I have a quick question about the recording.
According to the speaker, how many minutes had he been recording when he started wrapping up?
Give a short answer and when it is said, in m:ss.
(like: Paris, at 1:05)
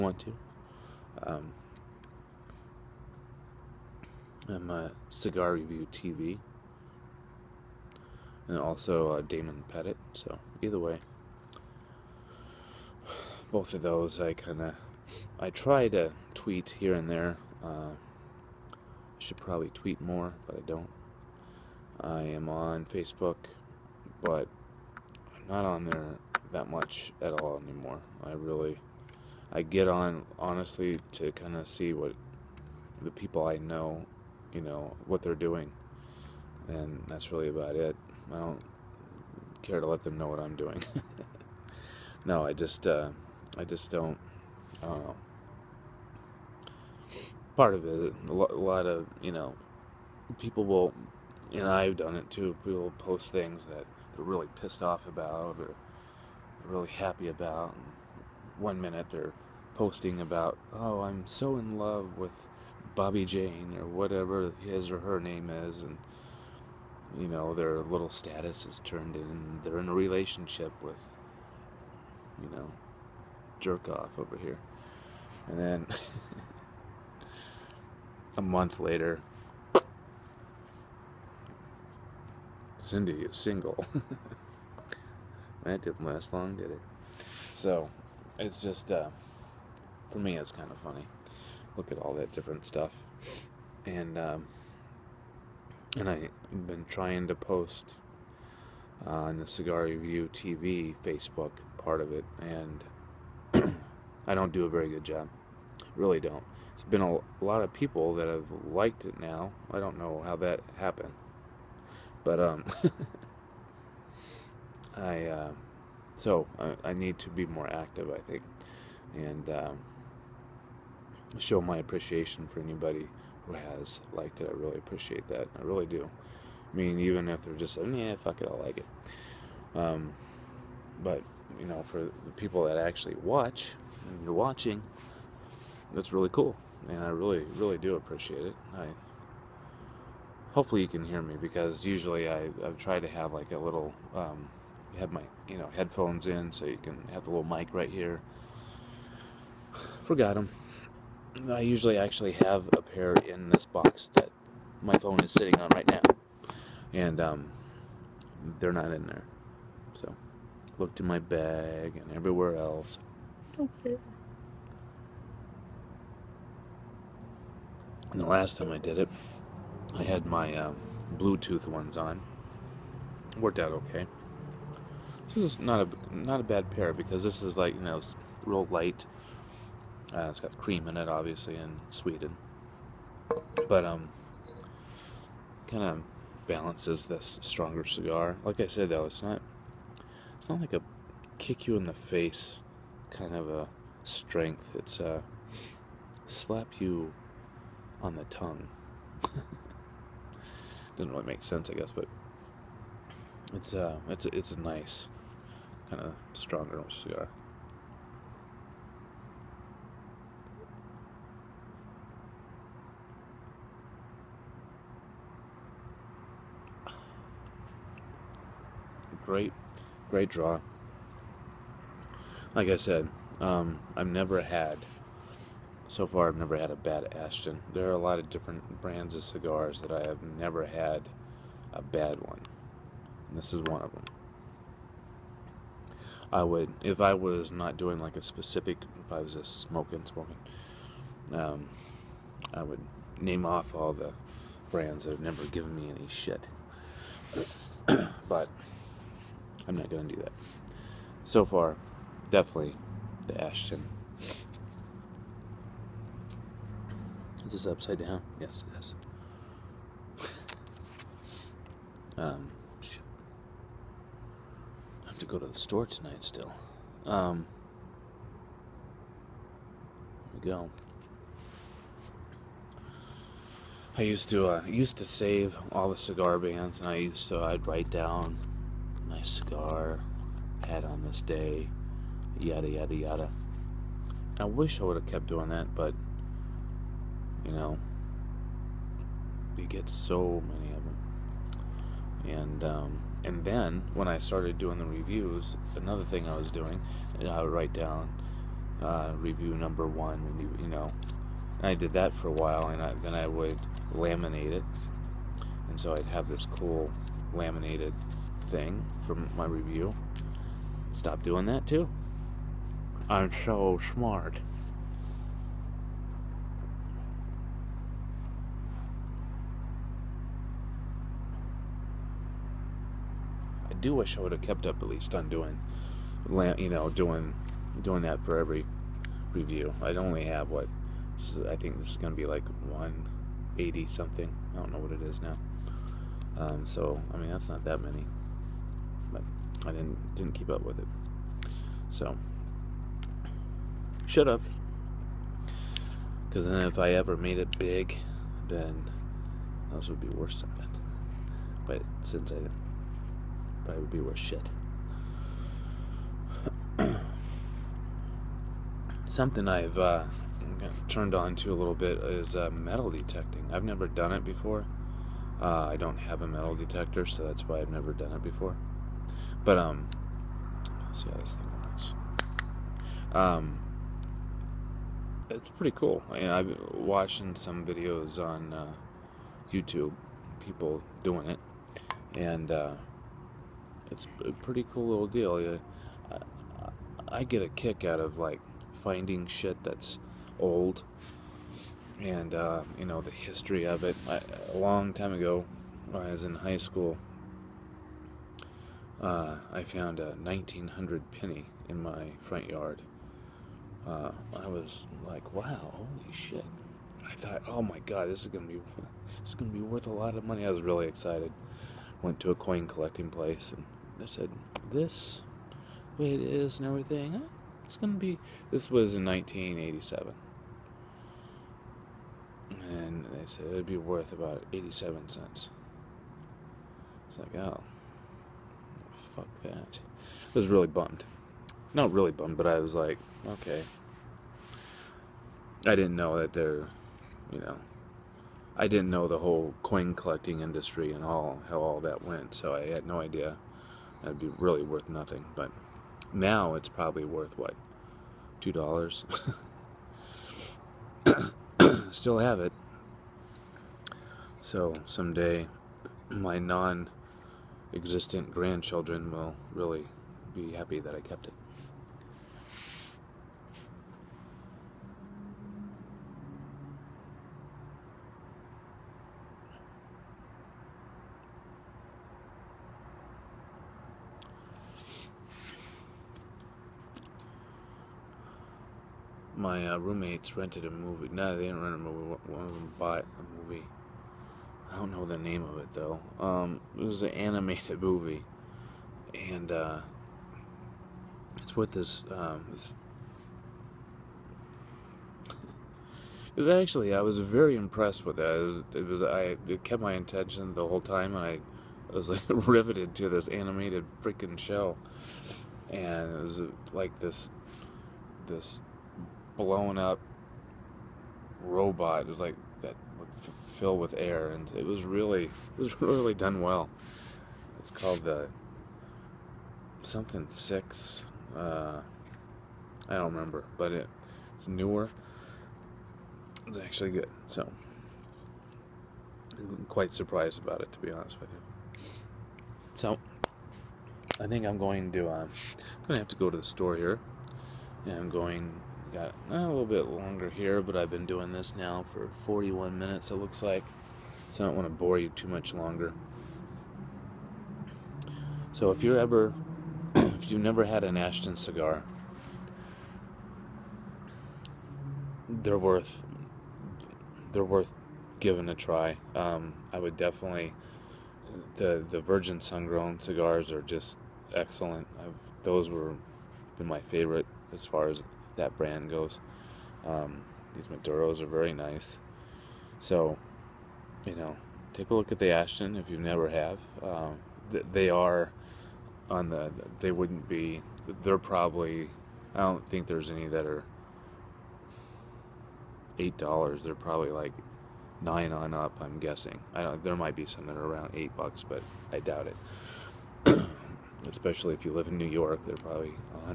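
41, at 9:02.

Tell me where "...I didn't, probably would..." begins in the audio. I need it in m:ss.
5:52.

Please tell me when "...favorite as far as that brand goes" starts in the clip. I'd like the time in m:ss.
9:26.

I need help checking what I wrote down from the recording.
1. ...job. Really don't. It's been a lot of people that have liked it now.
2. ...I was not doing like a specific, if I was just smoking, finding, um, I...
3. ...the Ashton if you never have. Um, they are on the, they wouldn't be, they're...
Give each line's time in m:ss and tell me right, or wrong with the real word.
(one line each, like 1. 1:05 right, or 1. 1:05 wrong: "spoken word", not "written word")
1. 1:45 right
2. 3:56 wrong: "smoking", not "finding"
3. 9:35 right.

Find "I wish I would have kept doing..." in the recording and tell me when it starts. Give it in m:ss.
4:44.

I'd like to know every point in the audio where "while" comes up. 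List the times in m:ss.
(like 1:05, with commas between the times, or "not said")
5:02.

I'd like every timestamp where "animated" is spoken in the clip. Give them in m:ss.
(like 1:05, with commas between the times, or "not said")
8:07, 8:23.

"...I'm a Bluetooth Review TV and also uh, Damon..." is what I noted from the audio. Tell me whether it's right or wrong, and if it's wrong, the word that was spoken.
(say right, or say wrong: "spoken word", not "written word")
wrong: "Cigar", not "Bluetooth".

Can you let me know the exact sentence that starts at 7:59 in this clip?
my uh, roommates rented a movie.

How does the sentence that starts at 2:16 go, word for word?
And I really, really do appreciate it.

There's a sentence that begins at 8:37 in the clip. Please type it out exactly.
It's called the uh, something six.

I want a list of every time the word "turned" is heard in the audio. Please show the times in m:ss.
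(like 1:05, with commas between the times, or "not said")
1:08, 6:00.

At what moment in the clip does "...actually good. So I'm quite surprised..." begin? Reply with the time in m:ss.
8:46.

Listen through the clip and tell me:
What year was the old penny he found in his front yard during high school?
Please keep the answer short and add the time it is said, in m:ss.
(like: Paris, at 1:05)
1900, at 6:40.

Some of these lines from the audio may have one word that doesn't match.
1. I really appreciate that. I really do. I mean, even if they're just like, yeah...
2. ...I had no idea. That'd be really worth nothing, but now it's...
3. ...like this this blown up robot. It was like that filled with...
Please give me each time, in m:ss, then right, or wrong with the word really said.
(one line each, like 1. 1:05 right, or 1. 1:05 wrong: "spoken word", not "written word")
1. 2:04 right
2. 7:22 right
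3. 8:26 right.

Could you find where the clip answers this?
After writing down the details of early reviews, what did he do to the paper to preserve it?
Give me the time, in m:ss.
5:03.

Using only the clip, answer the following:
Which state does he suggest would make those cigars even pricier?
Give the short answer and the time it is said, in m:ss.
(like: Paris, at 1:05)
New York, at 9:54.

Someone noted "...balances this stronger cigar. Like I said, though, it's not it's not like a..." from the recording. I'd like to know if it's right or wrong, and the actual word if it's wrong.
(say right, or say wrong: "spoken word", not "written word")
right.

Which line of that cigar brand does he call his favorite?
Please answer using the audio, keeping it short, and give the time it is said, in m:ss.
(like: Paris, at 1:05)
Virgin Sun Grown, at 9:22.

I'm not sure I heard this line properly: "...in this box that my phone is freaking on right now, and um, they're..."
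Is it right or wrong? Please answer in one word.
wrong.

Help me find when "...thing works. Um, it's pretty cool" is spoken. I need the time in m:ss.
6:11.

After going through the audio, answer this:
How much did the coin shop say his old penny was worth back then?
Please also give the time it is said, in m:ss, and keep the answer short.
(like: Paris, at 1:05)
87 cents, at 7:04.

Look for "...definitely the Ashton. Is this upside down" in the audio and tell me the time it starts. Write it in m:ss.
4:12.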